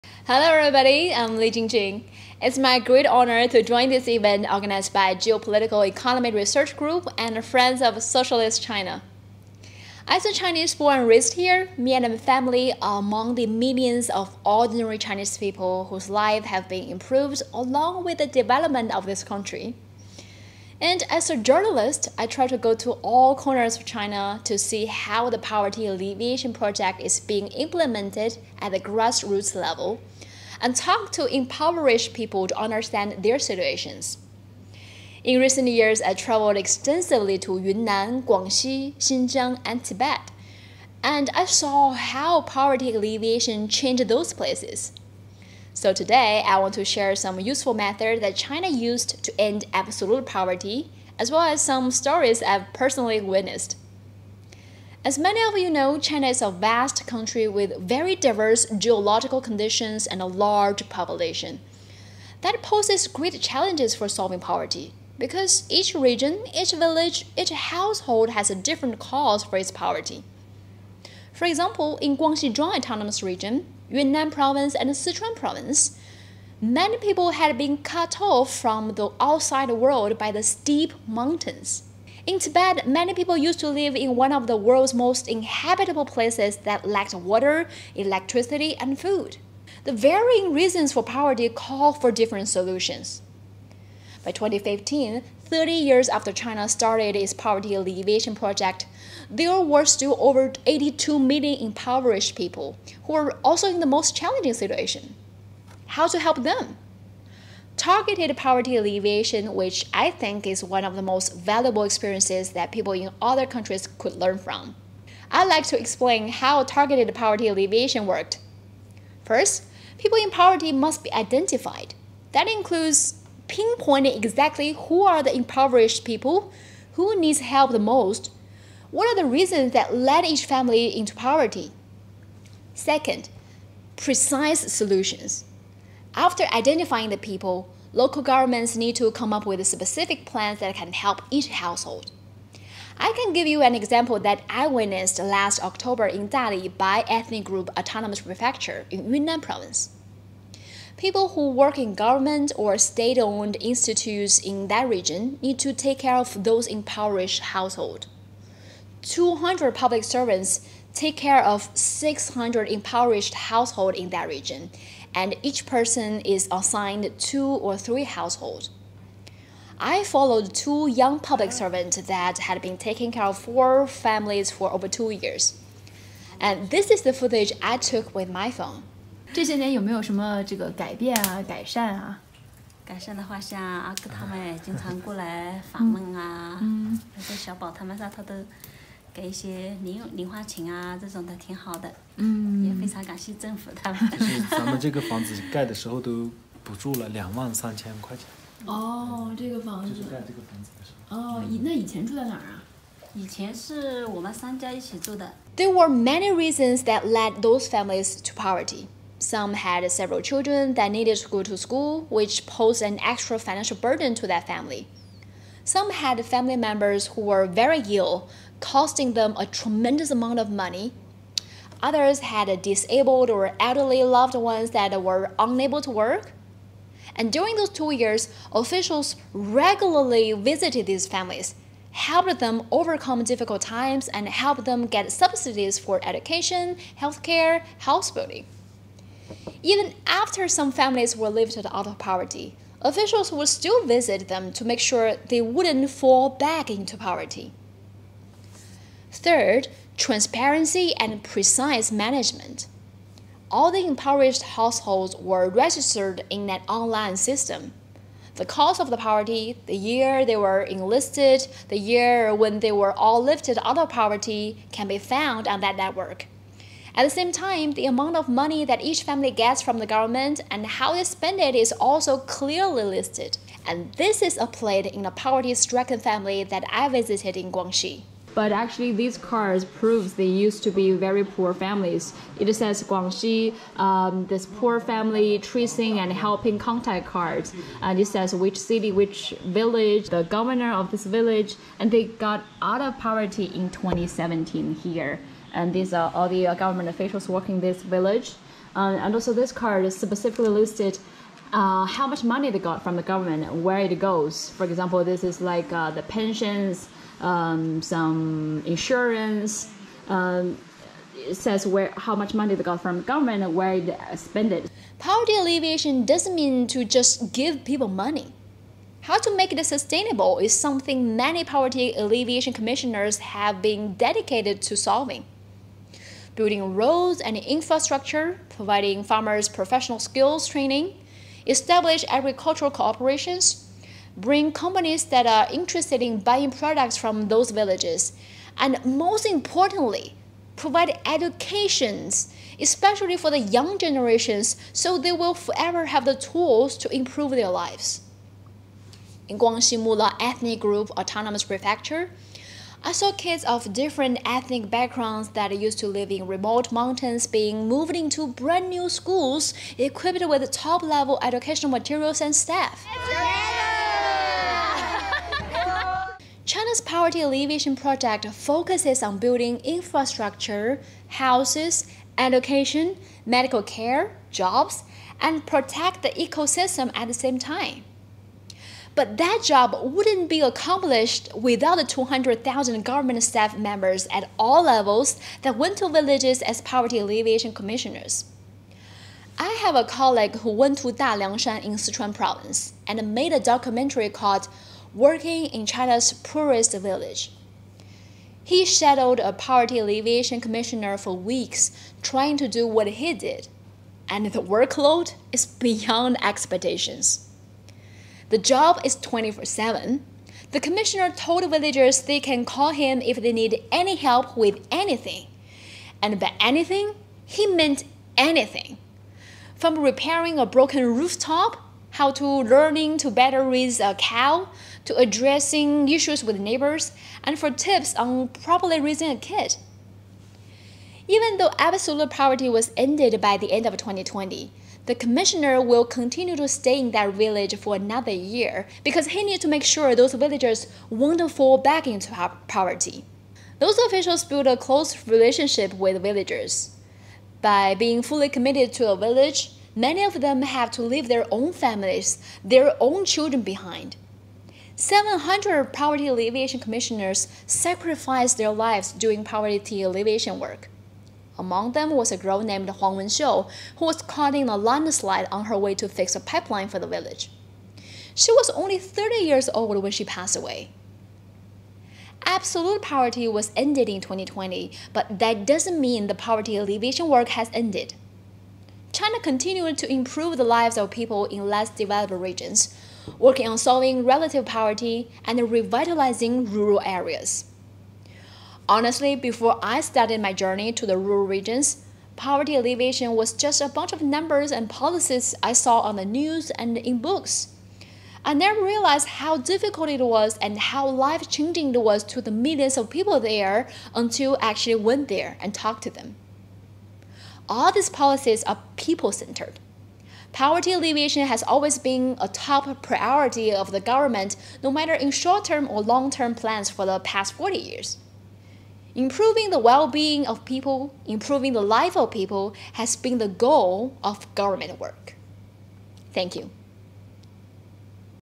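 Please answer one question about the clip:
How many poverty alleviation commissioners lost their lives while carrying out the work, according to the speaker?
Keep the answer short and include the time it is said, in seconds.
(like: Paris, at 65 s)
700, at 454 s.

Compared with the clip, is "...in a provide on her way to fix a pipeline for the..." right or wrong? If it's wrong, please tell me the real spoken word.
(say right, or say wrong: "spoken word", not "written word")
wrong: "landslide", not "provide".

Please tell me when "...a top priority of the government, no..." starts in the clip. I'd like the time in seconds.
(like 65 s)
512 s.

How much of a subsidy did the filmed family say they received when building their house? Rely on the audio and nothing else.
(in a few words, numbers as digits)
23,000 yuan.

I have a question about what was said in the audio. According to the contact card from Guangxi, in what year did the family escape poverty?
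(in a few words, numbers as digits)
2017.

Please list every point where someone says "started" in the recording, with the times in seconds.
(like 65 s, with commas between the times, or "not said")
96 s, 489 s.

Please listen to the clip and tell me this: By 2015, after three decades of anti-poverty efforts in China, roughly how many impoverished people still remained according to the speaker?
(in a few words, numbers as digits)
82 million.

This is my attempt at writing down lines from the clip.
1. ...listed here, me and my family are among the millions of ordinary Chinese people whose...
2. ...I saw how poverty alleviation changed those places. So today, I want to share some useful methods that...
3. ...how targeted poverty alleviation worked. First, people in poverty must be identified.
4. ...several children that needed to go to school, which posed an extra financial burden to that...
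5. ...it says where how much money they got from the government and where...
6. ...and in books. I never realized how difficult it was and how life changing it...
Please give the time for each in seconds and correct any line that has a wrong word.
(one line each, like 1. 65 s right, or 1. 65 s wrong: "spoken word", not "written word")
1. 11 s wrong: "raised", not "listed"
2. 41 s right
3. 116 s right
4. 209 s right
5. 311 s right
6. 496 s right.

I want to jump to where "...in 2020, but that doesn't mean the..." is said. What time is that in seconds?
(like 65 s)
473 s.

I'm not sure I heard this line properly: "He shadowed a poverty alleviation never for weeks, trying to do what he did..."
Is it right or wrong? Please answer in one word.
wrong.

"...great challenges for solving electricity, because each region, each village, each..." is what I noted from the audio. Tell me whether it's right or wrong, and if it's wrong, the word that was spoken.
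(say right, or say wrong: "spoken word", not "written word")
wrong: "poverty", not "electricity".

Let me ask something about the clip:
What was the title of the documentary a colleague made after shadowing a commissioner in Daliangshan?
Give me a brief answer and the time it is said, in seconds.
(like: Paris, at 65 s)
Working in China's Poorest Village, at 394 s.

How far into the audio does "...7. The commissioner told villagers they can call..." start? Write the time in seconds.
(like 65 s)
409 s.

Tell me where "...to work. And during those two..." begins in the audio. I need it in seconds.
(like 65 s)
225 s.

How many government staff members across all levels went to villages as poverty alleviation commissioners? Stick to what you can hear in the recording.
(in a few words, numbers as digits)
200,000.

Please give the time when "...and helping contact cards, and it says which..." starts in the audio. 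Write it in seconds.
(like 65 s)
285 s.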